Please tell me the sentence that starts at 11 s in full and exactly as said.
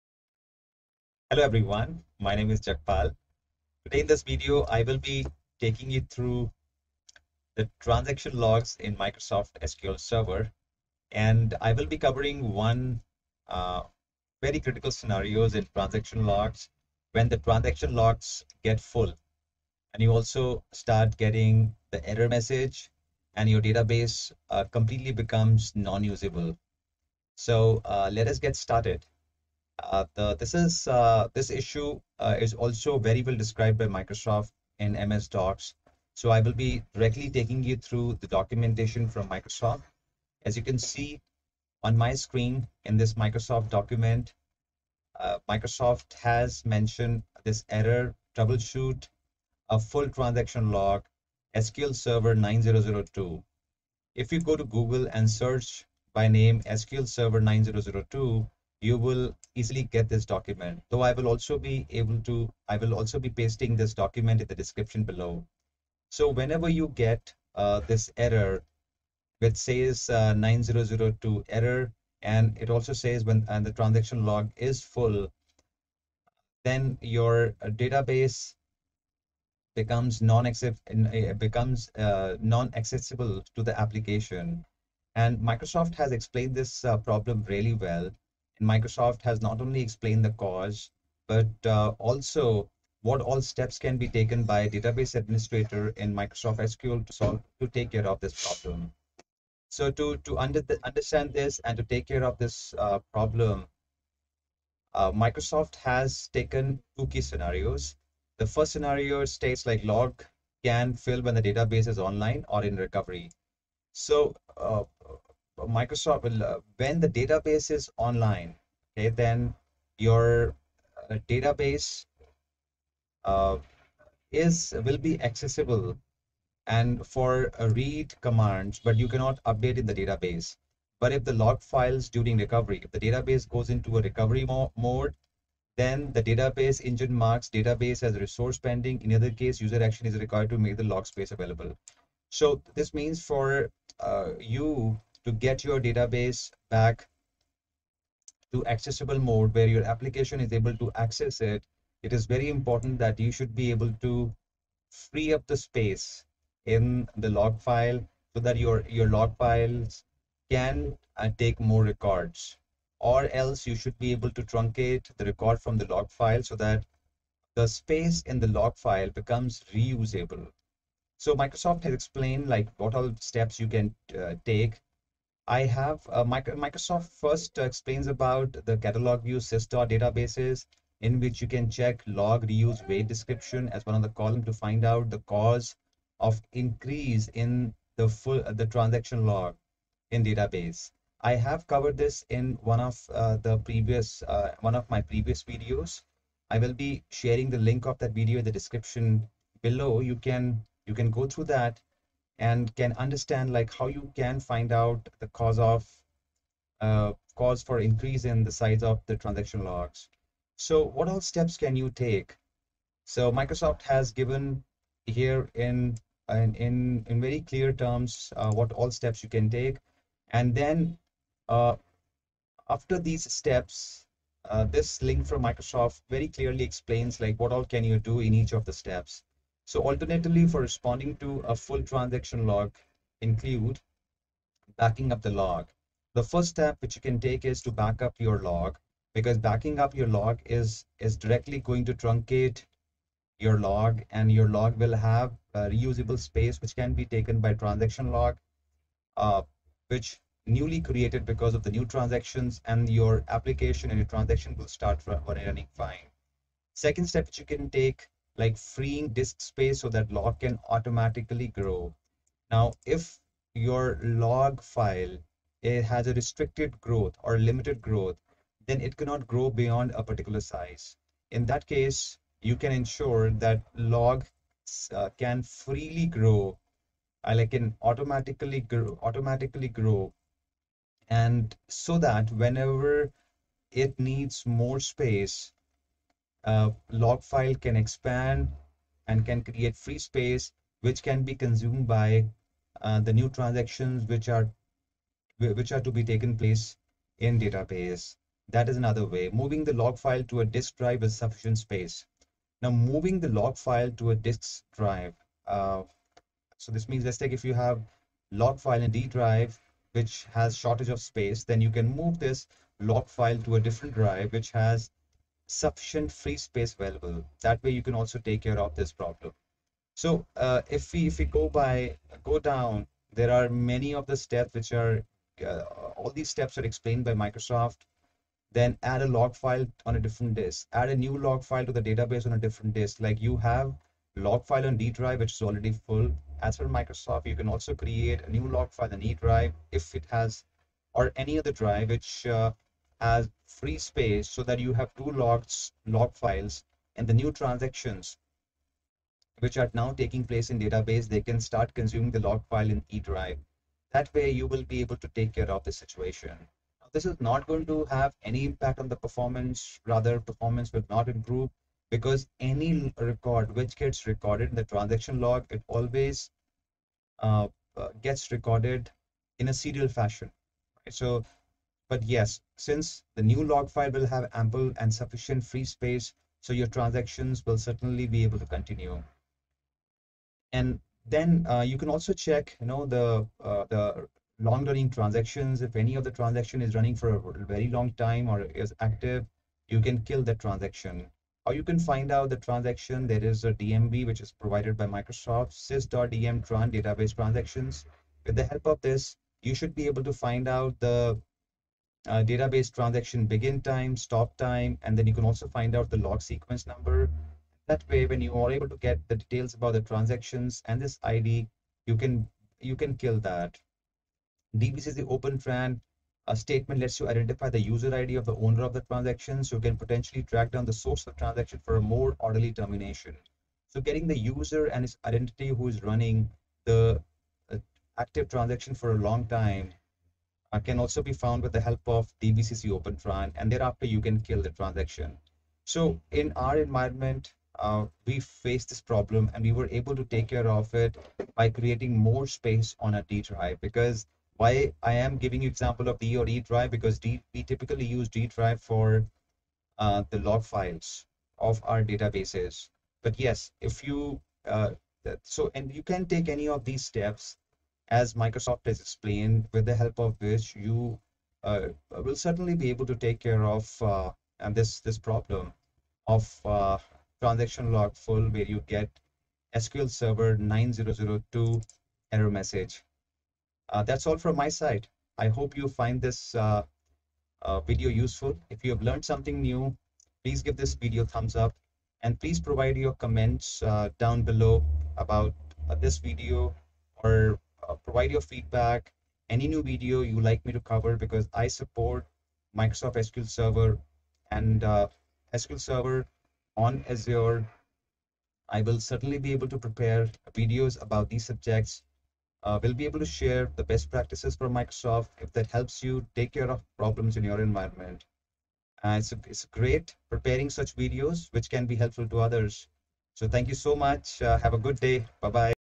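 And I will be covering one uh, very critical scenarios in transaction logs when the transaction logs get full.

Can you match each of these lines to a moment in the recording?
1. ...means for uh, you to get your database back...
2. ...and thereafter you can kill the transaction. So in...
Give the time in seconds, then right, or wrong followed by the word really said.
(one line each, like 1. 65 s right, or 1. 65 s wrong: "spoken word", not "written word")
1. 142 s right
2. 433 s right.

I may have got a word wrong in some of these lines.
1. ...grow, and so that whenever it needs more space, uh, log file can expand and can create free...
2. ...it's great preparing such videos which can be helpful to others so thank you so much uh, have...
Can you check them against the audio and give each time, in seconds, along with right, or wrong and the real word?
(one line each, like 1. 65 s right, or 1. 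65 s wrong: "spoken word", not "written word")
1. 279 s right
2. 509 s right.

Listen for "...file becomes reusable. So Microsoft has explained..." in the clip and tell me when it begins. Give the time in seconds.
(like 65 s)
168 s.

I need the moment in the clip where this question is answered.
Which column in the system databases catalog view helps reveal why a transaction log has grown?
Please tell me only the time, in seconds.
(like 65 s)
182 s.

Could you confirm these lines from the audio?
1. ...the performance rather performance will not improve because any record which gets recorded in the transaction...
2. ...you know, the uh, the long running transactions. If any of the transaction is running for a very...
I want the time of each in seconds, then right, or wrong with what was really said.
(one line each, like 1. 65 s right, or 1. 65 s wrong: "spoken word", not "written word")
1. 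358 s right
2. 382 s right.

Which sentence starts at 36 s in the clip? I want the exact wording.
So I will be directly taking you through the documentation from Microsoft.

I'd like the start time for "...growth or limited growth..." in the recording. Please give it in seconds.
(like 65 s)
266 s.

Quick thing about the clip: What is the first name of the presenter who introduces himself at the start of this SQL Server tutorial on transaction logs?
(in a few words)
Jagpal.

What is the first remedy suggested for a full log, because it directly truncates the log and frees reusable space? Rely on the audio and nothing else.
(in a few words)
backing up the log.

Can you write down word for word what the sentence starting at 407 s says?
That way, when you are able to get the details about the transactions and this ID, you can you can kill that.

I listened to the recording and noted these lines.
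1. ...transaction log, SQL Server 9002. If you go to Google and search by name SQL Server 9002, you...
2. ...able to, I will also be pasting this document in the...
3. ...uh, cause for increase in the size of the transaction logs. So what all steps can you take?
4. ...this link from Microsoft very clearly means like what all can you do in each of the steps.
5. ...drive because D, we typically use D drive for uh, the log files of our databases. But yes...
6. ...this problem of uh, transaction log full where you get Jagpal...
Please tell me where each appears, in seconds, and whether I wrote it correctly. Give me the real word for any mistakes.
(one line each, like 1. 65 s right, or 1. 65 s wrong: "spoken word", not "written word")
1. 50 s right
2. 61 s right
3. 206 s right
4. 224 s wrong: "explains", not "means"
5. 446 s right
6. 464 s wrong: "SQL", not "Jagpal".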